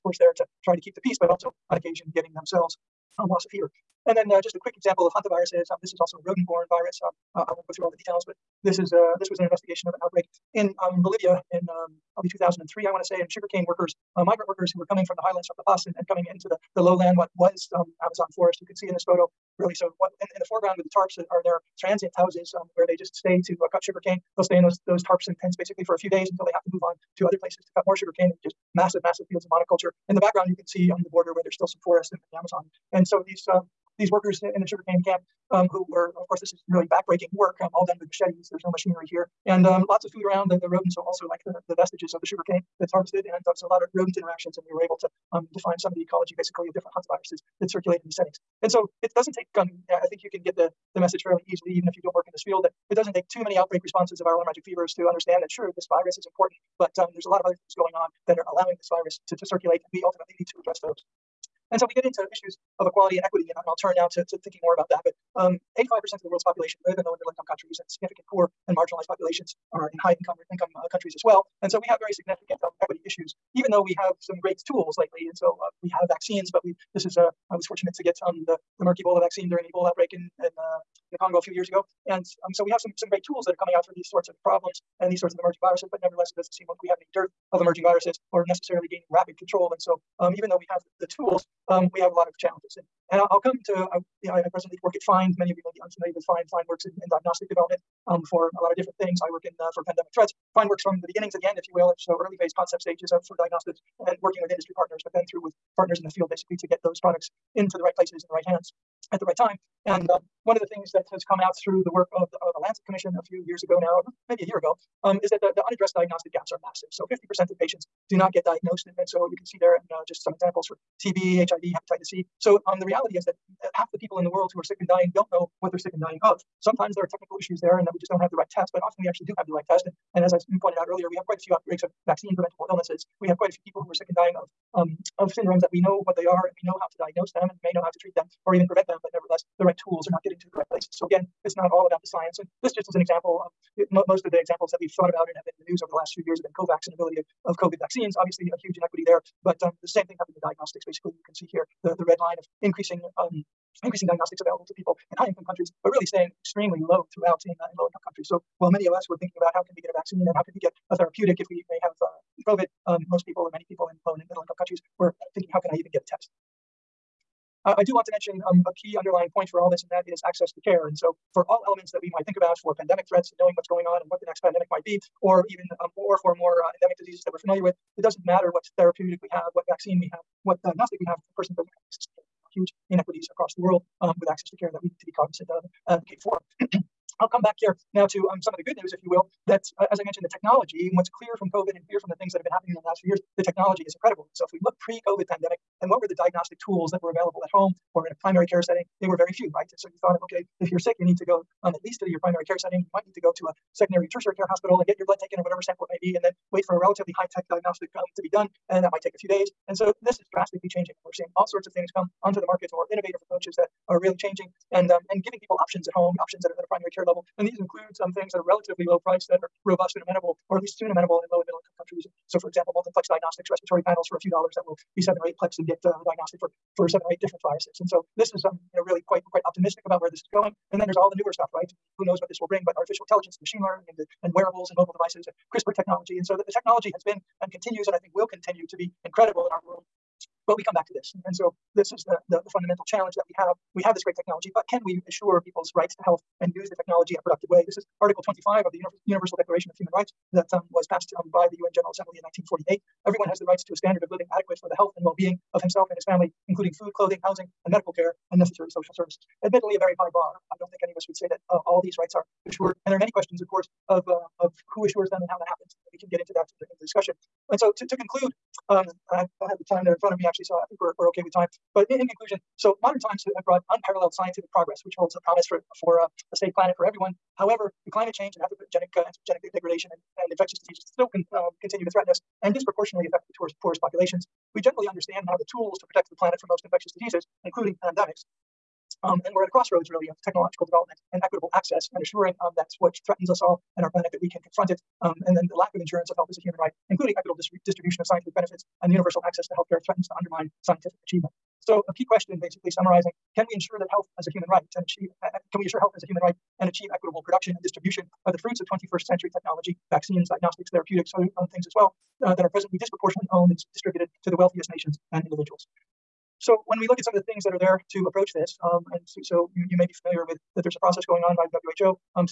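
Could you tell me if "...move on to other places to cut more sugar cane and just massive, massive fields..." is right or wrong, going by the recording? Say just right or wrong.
right.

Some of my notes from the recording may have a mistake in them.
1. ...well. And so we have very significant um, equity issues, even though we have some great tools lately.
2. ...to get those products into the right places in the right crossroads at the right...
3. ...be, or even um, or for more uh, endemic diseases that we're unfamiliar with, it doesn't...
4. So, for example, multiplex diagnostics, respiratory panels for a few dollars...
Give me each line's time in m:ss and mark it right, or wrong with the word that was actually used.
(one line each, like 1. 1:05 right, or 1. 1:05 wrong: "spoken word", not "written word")
1. 1:11 right
2. 1:46 wrong: "hands", not "crossroads"
3. 2:54 wrong: "familiar", not "unfamiliar"
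4. 3:42 right.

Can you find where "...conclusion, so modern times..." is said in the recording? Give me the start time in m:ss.
4:32.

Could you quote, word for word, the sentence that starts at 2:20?
So again, it's not all about the science.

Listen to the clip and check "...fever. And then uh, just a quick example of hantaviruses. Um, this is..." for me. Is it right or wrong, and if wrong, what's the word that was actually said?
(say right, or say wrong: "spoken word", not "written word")
right.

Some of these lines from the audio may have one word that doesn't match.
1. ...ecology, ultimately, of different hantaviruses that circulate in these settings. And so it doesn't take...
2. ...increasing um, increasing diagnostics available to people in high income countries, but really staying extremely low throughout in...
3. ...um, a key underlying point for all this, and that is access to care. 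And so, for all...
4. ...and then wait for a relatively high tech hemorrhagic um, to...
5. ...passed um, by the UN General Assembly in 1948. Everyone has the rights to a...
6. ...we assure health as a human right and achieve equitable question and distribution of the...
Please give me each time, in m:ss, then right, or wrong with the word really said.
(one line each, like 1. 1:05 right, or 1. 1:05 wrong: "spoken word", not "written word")
1. 0:46 wrong: "basically", not "ultimately"
2. 2:32 right
3. 2:48 right
4. 3:26 wrong: "diagnostic", not "hemorrhagic"
5. 4:10 right
6. 5:05 wrong: "production", not "question".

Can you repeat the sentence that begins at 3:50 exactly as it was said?
And then there's all the newer stuff, right?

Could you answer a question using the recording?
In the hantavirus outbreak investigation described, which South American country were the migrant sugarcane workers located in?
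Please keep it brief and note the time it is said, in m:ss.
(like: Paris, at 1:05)
Bolivia, at 0:11.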